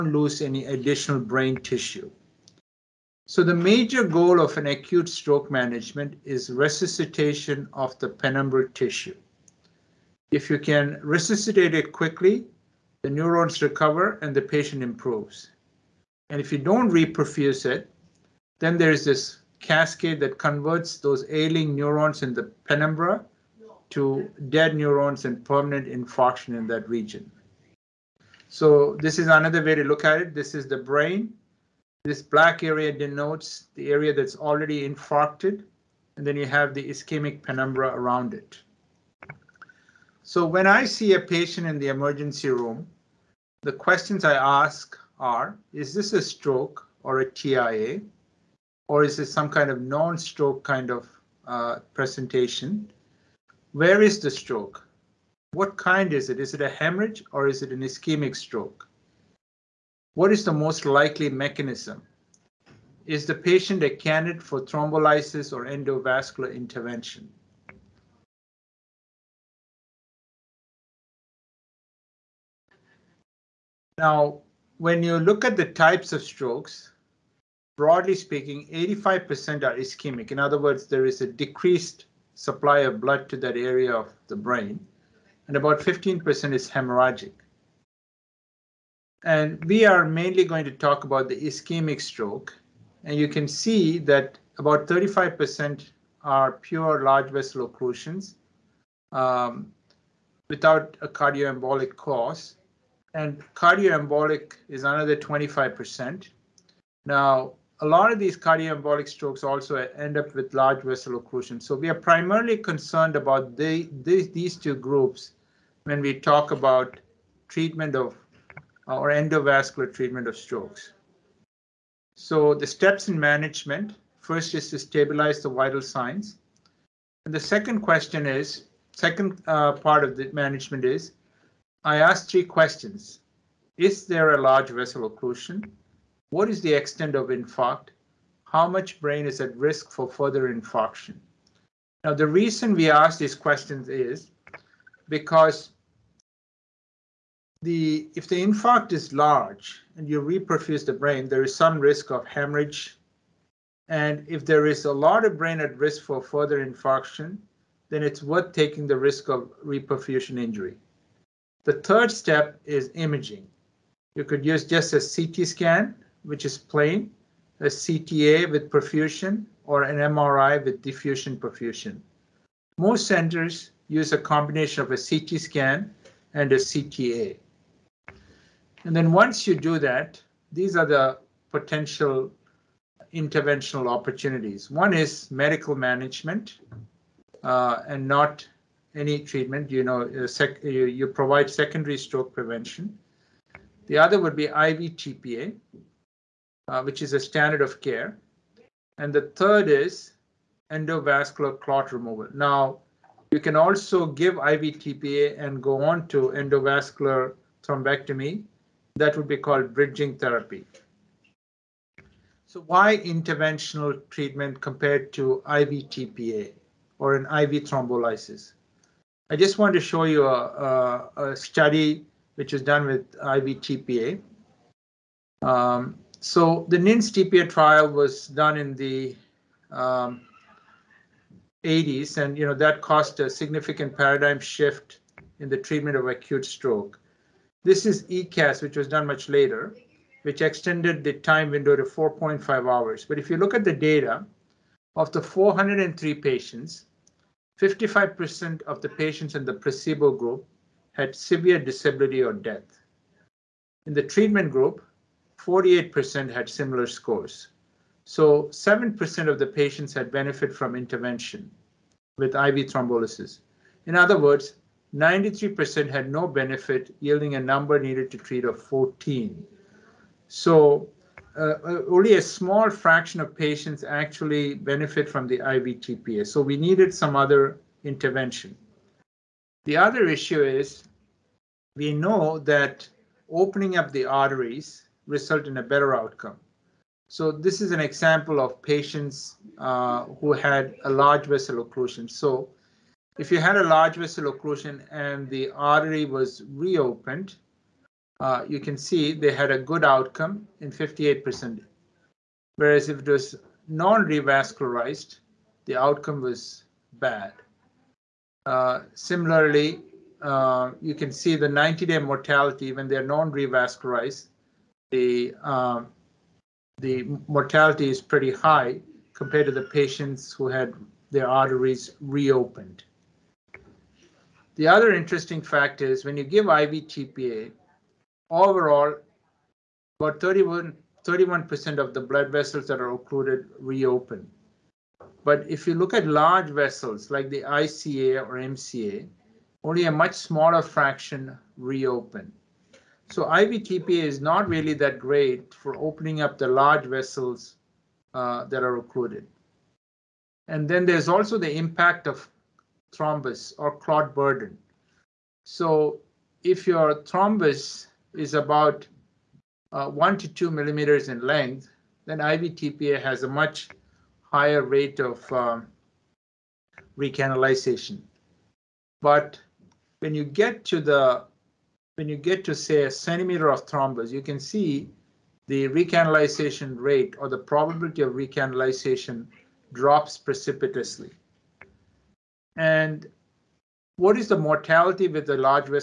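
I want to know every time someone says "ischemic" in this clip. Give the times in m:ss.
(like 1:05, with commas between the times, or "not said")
0:36, 0:57, 1:19, 1:31.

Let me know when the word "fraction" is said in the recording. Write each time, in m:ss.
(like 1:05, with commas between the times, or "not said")
4:32, 5:40.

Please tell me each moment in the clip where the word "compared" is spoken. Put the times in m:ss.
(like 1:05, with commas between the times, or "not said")
3:34, 5:19.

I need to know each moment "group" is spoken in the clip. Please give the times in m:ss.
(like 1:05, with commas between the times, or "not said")
1:54, 4:10, 4:14.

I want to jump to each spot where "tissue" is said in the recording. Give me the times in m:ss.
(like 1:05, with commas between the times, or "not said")
0:01, 0:08.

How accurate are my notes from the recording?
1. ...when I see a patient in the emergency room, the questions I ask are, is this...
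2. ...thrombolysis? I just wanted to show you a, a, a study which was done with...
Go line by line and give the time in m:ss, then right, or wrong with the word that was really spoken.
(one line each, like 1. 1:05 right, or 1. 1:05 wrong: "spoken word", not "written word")
1. 0:40 right
2. 3:37 right.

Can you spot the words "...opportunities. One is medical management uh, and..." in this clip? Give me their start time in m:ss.
3:03.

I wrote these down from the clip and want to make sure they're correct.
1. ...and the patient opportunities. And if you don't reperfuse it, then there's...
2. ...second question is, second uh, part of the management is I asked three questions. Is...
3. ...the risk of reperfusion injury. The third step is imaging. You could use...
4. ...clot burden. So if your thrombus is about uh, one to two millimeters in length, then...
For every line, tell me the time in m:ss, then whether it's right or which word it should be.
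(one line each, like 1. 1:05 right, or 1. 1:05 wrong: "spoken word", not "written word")
1. 0:14 wrong: "improves", not "opportunities"
2. 2:07 right
3. 2:38 right
4. 5:53 right.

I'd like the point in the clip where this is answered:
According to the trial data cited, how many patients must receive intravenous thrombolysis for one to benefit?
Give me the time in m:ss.
4:27.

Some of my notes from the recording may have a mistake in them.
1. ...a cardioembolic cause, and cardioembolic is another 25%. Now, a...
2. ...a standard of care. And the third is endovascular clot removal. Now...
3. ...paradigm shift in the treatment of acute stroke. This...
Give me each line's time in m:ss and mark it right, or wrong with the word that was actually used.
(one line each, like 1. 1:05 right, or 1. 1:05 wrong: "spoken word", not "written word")
1. 1:41 right
2. 3:17 right
3. 3:53 right.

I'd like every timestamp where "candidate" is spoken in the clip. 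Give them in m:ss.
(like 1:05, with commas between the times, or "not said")
1:03.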